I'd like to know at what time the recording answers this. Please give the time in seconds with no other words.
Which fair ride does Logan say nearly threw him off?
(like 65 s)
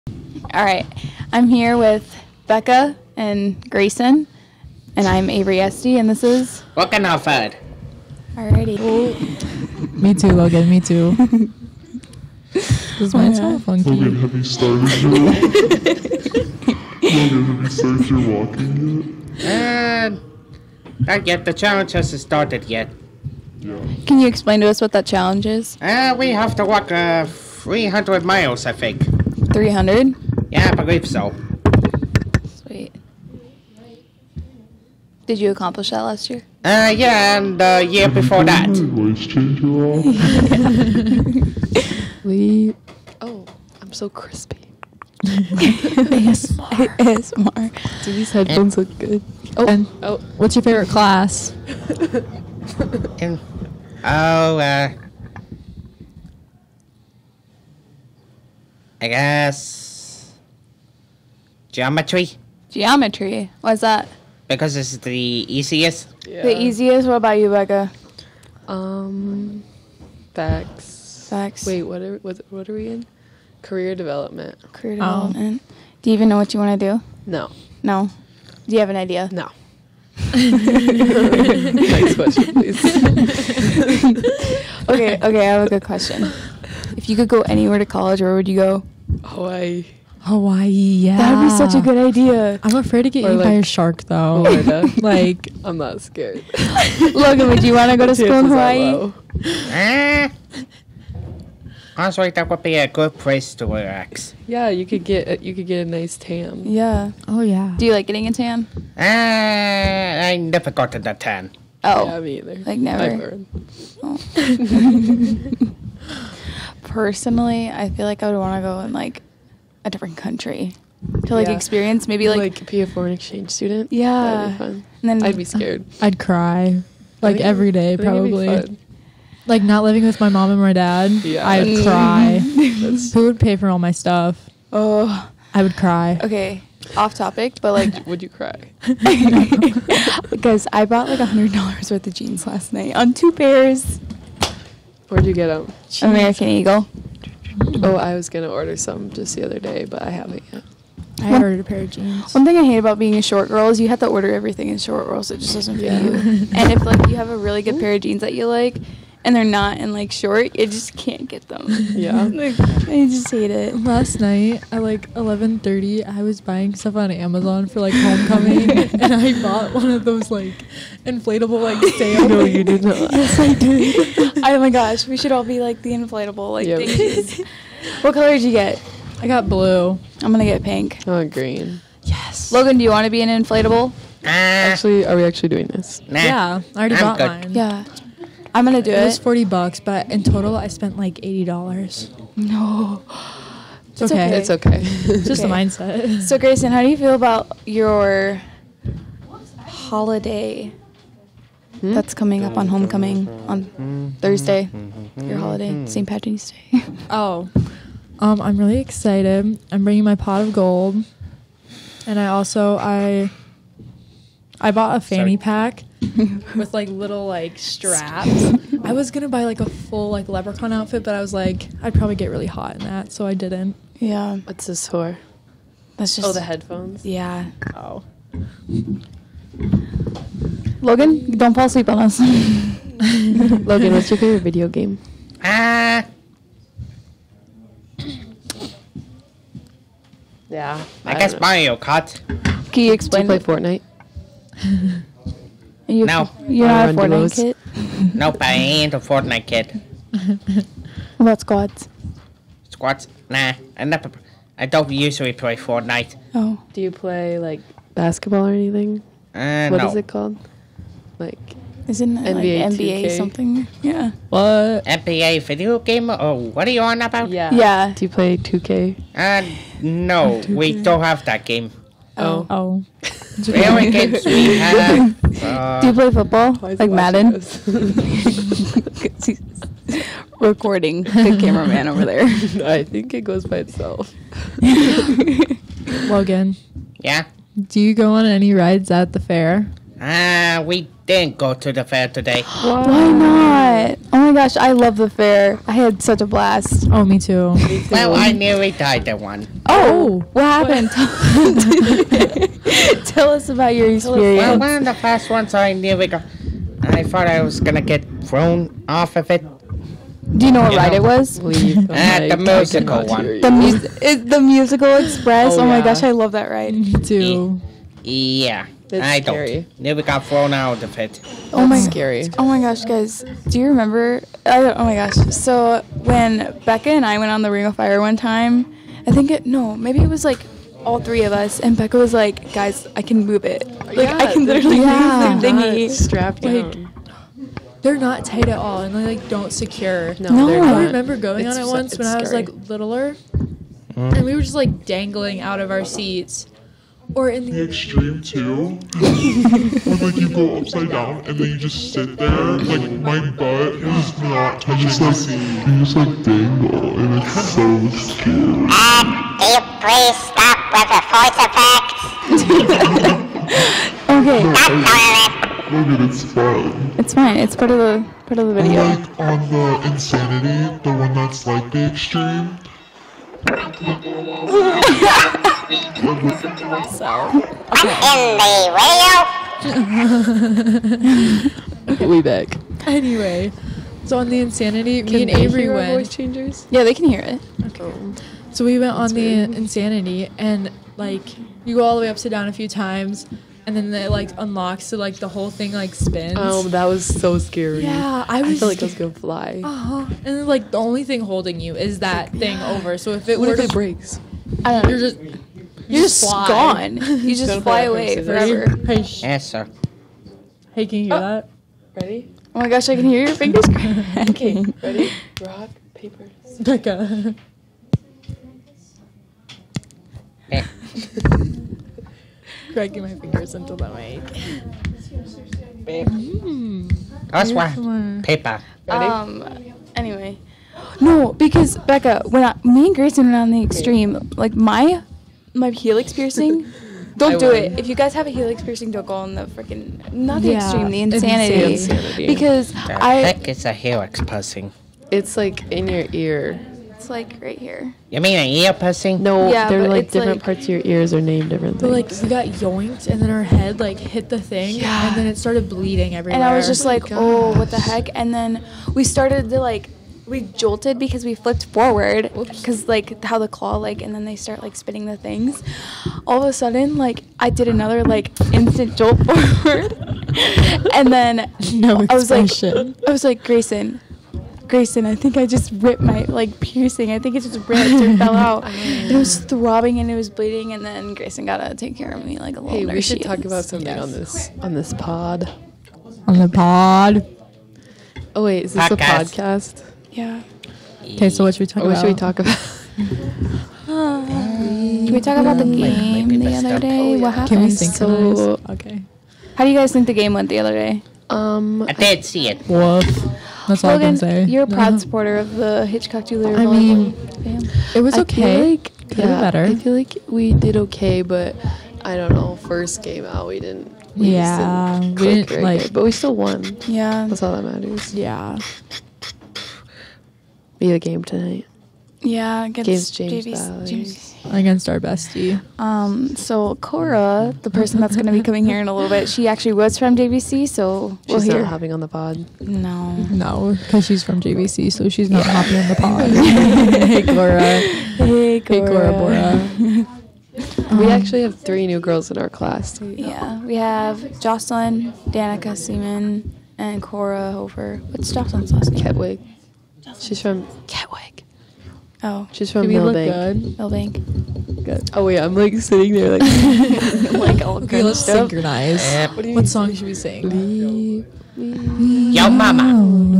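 314 s.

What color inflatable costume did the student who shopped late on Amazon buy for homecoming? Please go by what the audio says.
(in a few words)
Blue.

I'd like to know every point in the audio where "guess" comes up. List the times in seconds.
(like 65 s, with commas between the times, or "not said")
59 s, 241 s.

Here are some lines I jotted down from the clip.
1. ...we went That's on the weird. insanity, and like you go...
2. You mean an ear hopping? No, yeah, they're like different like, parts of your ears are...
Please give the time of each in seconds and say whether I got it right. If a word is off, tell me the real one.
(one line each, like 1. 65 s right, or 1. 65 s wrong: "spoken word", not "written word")
1. 388 s right
2. 448 s wrong: "piercing", not "hopping".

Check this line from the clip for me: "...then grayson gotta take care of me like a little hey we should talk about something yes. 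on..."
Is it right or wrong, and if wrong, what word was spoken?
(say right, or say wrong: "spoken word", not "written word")
right.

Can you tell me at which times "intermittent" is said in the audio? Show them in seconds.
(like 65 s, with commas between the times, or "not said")
not said.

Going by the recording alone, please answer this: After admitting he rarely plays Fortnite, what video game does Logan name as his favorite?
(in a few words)
Mario Kart.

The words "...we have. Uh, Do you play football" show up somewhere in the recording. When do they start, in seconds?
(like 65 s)
274 s.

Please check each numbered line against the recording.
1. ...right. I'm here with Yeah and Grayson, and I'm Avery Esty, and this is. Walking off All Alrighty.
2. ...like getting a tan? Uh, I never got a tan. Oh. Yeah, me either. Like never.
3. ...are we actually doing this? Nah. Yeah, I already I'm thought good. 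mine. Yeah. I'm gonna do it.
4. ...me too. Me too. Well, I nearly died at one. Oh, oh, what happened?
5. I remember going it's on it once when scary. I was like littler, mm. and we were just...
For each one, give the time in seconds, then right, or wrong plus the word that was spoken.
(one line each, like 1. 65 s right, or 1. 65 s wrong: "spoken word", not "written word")
1. 0 s wrong: "Becca", not "Yeah"
2. 107 s right
3. 185 s wrong: "bought", not "thought"
4. 297 s right
5. 340 s right.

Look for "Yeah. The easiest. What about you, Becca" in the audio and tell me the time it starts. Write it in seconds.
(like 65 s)
66 s.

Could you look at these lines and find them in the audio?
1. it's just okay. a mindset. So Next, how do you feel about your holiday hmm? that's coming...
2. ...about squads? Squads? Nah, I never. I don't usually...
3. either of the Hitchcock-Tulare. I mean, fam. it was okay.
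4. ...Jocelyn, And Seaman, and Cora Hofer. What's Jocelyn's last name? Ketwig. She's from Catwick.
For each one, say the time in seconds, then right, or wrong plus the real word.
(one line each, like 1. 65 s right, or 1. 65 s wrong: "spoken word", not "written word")
1. 194 s wrong: "Grayson", not "Next"
2. 251 s right
3. 504 s wrong: "supporter", not "either"
4. 544 s wrong: "Danica", not "And".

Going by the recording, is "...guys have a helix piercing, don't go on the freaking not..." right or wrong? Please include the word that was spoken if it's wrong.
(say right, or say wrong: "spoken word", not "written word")
right.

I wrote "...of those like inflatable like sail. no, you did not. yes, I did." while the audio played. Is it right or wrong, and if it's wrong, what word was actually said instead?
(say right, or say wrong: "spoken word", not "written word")
right.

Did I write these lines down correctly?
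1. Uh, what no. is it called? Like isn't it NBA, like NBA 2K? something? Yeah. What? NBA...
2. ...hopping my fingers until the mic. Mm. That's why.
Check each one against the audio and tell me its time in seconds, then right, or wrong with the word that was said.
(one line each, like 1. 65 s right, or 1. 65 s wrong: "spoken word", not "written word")
1. 259 s right
2. 422 s wrong: "cracking", not "hopping".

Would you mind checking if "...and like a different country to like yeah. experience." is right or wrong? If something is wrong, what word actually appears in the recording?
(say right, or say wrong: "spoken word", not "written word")
right.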